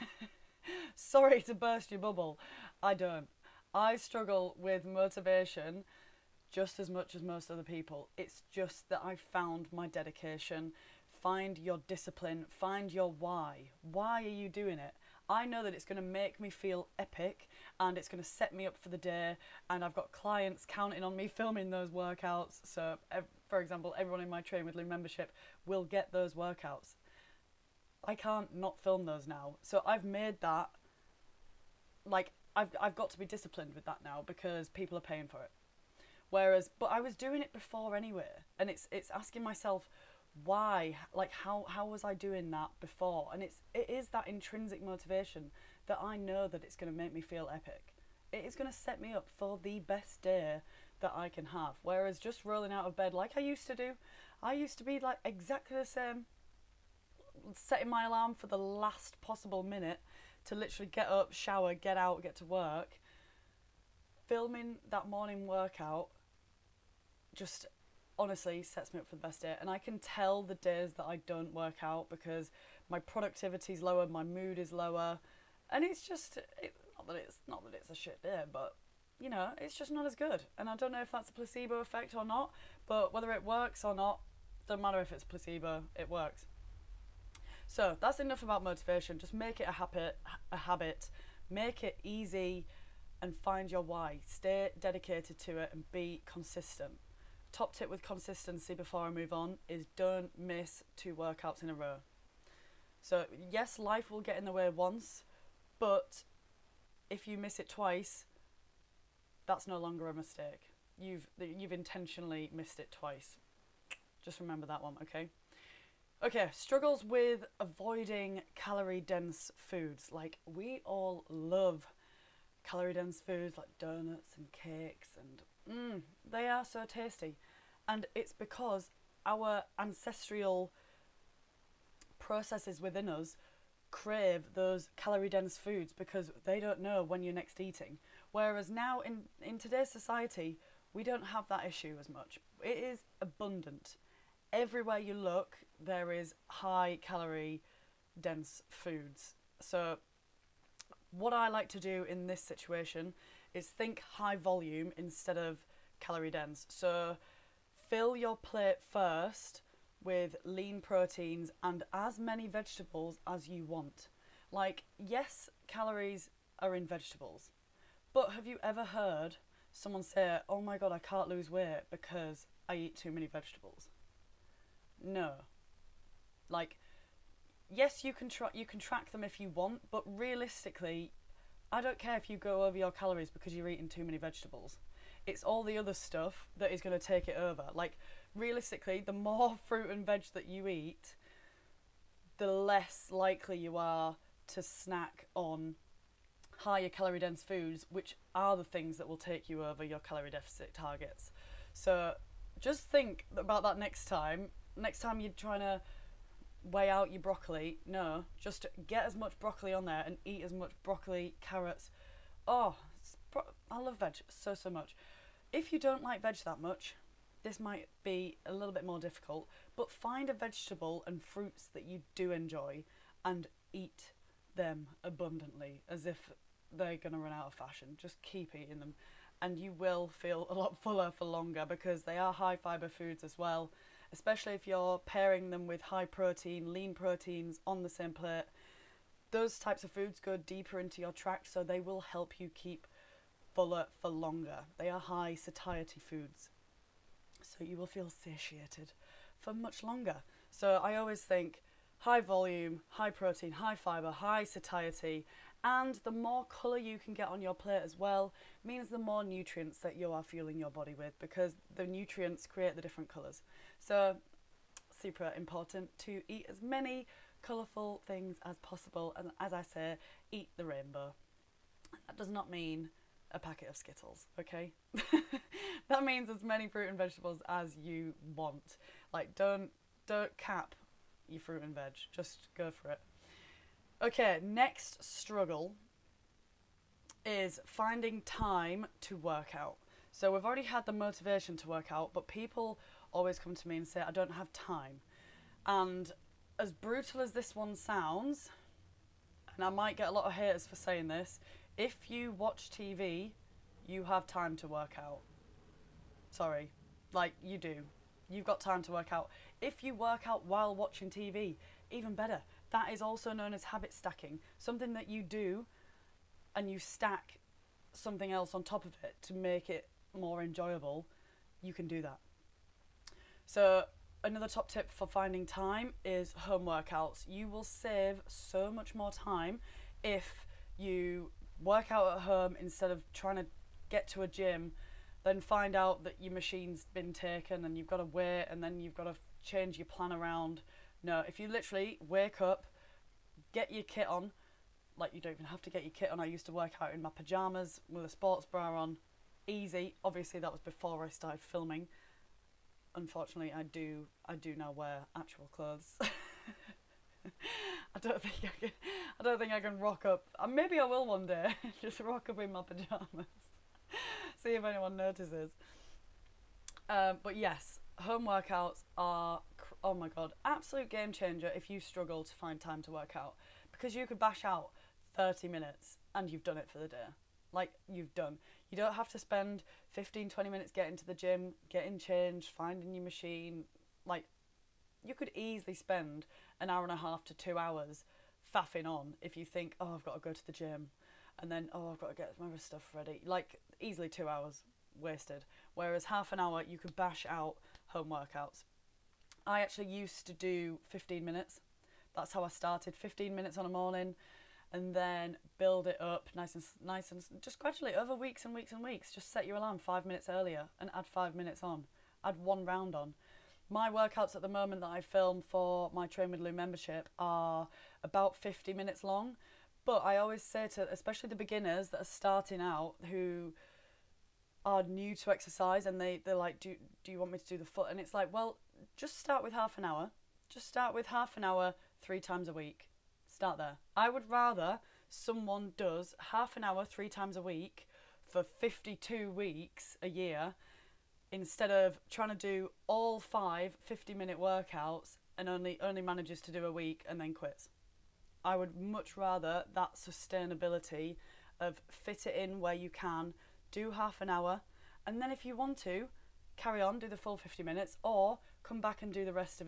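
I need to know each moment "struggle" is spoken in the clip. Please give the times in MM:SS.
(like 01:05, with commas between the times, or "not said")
00:03, 01:56, 04:45, 06:11.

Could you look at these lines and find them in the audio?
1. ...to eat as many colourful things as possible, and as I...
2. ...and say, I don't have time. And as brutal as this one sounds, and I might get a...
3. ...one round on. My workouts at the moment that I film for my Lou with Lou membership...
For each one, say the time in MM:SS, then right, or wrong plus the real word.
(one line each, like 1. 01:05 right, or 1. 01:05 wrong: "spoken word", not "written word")
1. 04:25 right
2. 04:53 right
3. 06:52 wrong: "Train", not "Lou".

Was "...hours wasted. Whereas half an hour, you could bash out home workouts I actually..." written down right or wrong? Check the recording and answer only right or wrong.
right.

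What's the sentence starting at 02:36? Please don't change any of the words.
So fill your plate first with lean proteins and as many vegetables as you want.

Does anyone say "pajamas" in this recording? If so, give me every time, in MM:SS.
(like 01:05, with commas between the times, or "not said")
05:47, 06:02.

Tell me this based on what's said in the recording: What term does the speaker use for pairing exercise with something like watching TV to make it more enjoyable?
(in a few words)
habit stacking.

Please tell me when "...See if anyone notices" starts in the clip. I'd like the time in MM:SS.
06:04.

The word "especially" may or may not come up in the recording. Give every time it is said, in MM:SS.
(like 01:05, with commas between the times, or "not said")
03:54, 07:00.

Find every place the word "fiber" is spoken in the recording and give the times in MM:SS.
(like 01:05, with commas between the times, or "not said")
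03:52, 04:13.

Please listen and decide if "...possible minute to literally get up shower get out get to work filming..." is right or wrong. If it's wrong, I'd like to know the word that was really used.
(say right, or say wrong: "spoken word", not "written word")
right.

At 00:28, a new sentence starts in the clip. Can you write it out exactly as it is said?
I can't not film those now.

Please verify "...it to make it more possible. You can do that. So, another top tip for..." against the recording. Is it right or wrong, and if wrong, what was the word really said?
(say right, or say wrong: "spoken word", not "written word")
wrong: "enjoyable", not "possible".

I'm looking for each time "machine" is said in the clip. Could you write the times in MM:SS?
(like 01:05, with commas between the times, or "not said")
05:36, 06:23.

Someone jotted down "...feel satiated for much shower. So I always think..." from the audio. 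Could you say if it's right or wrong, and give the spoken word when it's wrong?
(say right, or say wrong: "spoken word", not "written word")
wrong: "longer", not "shower".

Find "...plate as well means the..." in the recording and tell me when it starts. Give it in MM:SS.
04:17.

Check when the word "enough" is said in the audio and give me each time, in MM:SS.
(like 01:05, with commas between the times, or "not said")
01:28.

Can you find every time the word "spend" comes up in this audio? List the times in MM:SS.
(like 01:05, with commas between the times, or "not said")
06:19, 06:25.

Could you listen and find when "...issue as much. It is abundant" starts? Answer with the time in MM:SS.
02:21.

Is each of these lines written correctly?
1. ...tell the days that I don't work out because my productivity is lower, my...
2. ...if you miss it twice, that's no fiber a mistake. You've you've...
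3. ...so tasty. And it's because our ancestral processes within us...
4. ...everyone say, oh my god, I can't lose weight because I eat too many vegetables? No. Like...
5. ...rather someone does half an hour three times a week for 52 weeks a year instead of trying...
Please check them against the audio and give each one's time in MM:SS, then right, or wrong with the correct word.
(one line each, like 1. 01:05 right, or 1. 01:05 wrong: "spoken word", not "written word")
1. 01:09 right
2. 01:47 wrong: "longer", not "fiber"
3. 02:06 right
4. 02:49 wrong: "someone", not "everyone"
5. 07:14 right.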